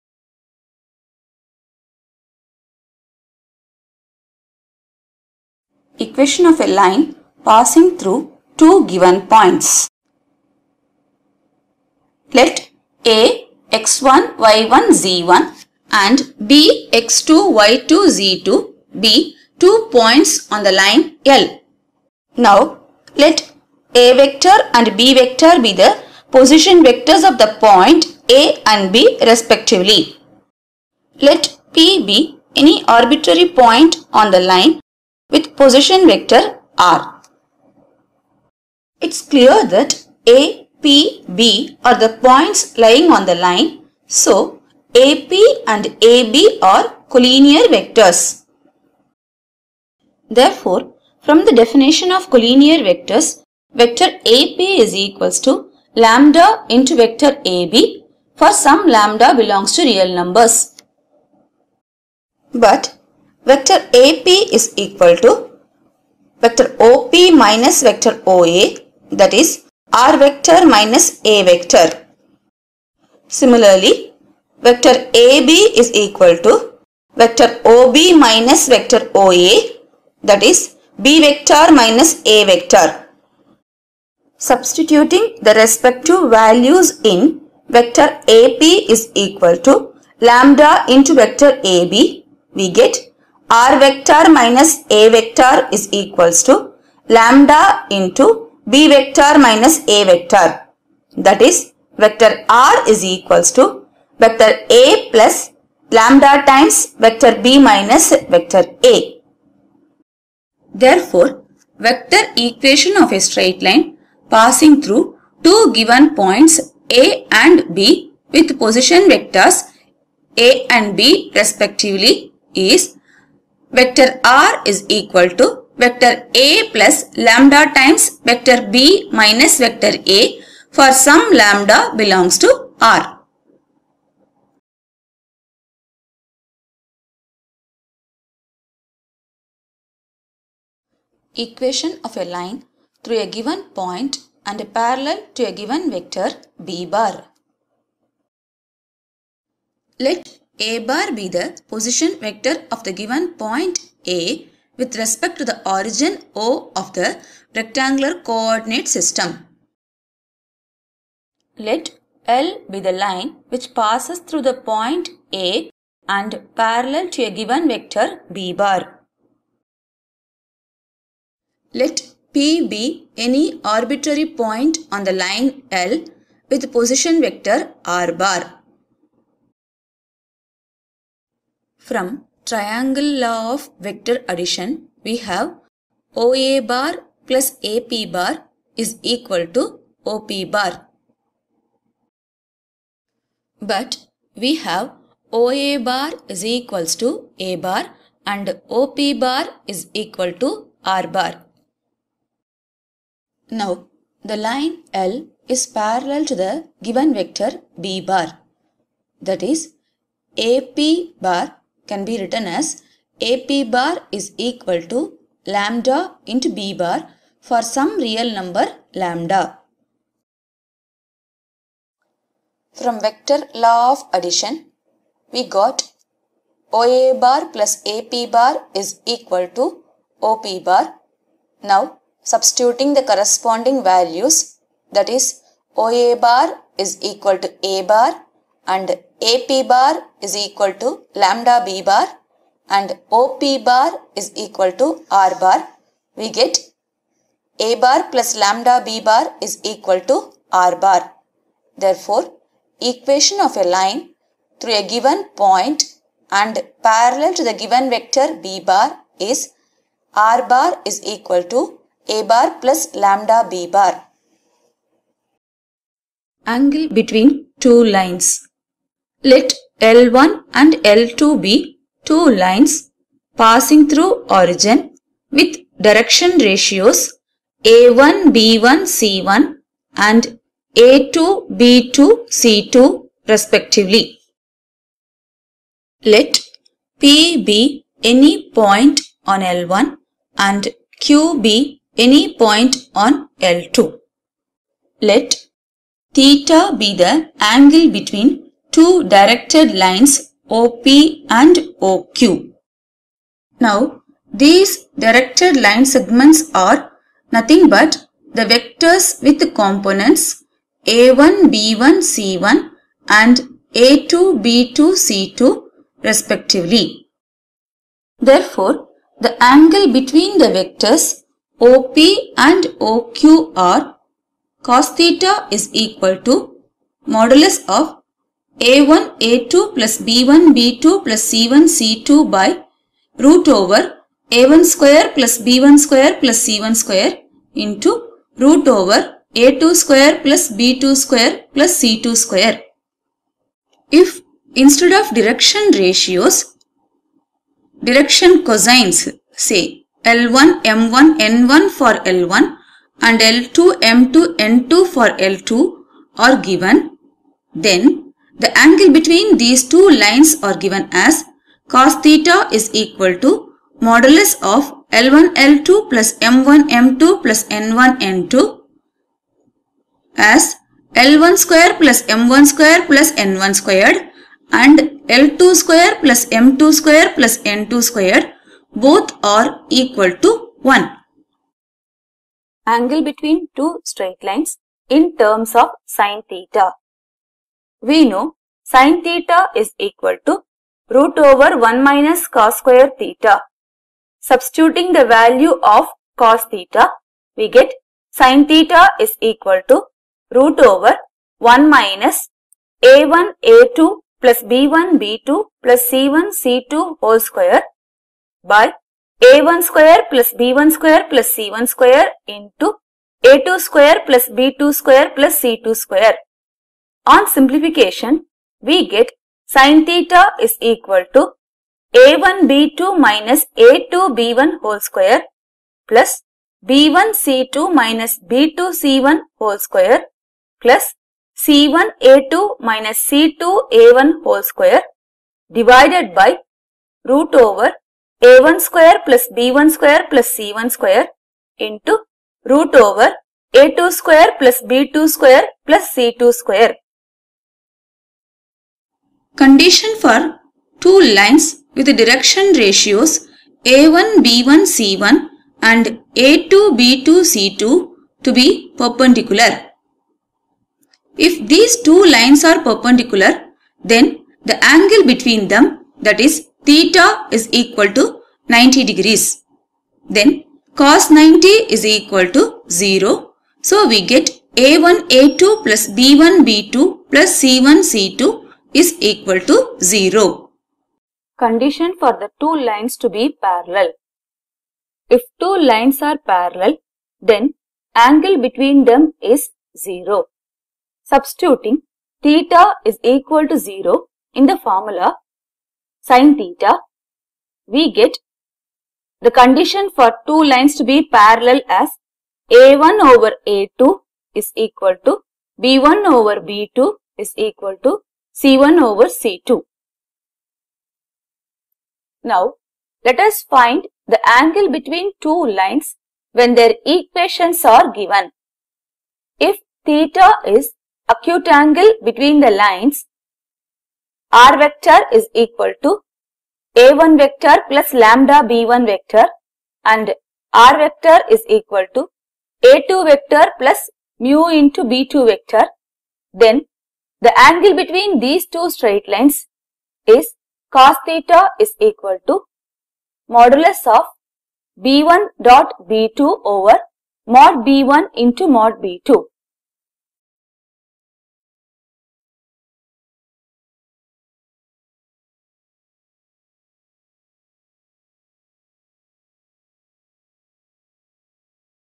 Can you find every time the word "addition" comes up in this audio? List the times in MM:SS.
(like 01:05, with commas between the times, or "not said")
03:04, 03:44.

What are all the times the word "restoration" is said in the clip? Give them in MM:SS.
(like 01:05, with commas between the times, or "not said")
not said.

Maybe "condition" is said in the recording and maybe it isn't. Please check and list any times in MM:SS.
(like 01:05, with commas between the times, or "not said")
07:29, 08:01, 08:19.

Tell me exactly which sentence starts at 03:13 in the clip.
But we have OA bar is equals to A bar and OP bar is equal to R bar.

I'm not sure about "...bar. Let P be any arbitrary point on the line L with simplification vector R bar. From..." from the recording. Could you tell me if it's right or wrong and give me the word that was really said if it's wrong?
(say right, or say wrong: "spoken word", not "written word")
wrong: "position", not "simplification".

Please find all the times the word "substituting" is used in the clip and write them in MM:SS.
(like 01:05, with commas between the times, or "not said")
01:24, 03:52, 06:34, 08:11.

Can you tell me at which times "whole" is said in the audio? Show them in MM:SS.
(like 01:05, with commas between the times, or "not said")
06:47, 07:04, 07:09, 07:14.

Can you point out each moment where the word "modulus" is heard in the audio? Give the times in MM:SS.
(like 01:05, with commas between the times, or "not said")
05:27, 06:03, 09:03.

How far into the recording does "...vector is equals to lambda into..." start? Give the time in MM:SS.
01:35.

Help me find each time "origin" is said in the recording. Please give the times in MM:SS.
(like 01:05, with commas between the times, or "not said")
02:35, 04:34.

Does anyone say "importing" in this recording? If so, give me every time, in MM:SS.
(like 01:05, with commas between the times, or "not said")
not said.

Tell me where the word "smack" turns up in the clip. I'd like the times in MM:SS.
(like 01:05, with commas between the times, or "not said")
not said.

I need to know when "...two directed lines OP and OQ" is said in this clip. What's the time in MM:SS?
04:58.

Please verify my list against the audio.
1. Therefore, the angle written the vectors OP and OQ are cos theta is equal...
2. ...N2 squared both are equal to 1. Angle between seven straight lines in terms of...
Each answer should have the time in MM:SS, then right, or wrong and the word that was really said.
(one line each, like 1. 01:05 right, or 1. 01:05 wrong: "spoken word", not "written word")
1. 05:18 wrong: "between", not "written"
2. 06:17 wrong: "two", not "seven".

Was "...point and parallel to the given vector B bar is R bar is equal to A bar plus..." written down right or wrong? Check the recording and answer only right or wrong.
right.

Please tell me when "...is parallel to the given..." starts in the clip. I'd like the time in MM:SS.
03:25.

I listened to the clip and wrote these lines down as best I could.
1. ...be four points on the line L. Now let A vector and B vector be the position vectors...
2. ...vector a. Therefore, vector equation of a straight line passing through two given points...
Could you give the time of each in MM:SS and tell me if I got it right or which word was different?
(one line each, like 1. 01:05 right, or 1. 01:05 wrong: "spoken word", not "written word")
1. 00:19 wrong: "two", not "four"
2. 01:48 right.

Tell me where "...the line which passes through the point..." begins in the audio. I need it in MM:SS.
02:42.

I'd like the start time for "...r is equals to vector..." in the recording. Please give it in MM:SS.
01:42.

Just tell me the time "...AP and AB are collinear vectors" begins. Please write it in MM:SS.
00:45.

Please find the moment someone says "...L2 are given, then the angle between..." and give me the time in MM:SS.
05:55.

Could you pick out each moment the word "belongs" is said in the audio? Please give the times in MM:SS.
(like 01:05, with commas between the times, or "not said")
00:59, 02:12.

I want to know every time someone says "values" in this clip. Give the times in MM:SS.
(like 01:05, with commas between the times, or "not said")
01:26, 03:53, 06:35.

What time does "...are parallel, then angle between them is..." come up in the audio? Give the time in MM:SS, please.
08:06.